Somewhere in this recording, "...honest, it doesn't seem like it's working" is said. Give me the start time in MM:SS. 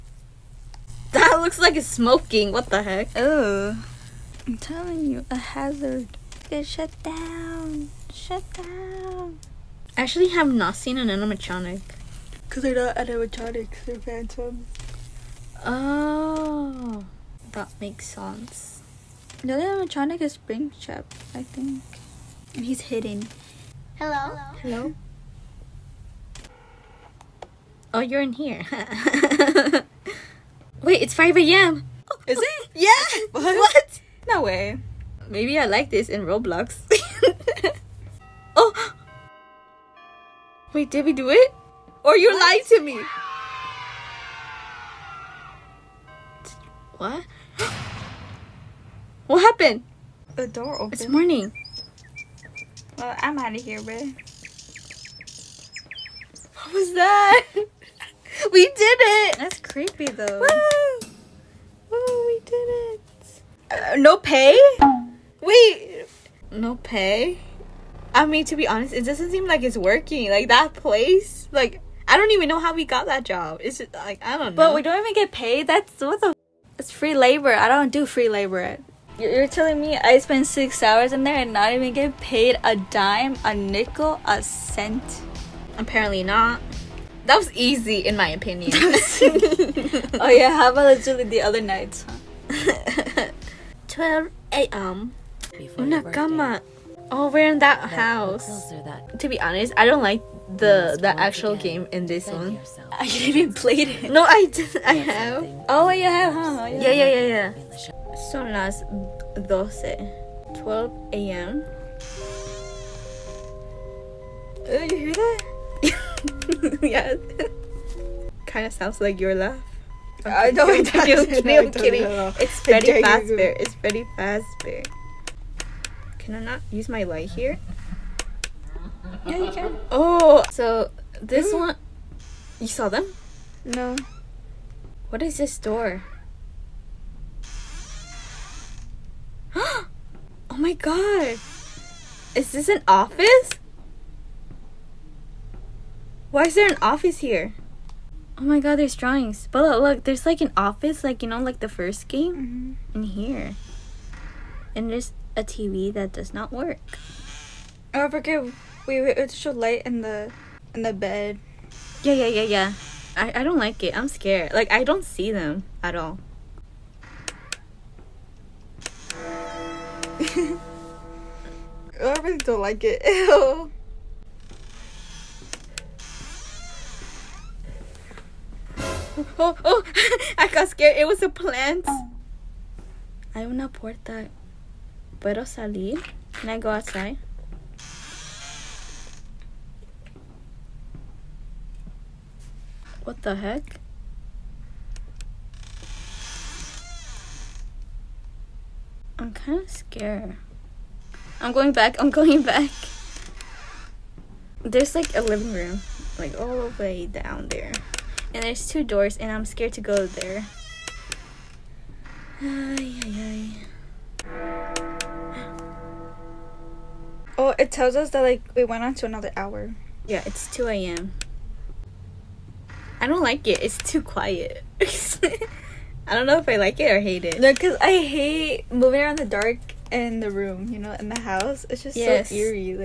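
01:08.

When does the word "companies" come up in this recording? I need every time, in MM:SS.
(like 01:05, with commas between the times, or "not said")
not said.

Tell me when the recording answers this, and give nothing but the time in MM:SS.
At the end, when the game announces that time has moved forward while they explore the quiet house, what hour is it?
03:40.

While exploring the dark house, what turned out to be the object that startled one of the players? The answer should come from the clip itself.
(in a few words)
A plant.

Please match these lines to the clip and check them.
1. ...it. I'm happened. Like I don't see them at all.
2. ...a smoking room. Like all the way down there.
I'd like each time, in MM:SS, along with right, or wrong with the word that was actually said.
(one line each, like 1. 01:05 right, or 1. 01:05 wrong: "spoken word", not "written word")
1. 02:43 wrong: "scared", not "happened"
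2. 03:25 wrong: "living", not "smoking".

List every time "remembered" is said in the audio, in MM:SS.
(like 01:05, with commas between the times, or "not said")
not said.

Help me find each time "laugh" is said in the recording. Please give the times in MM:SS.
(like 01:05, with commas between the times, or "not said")
01:59.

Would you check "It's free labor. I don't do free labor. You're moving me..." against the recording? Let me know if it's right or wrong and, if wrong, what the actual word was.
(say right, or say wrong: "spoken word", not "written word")
wrong: "telling", not "moving".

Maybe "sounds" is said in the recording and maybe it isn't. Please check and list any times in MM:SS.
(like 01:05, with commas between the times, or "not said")
01:58.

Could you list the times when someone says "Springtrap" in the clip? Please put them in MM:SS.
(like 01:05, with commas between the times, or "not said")
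00:20.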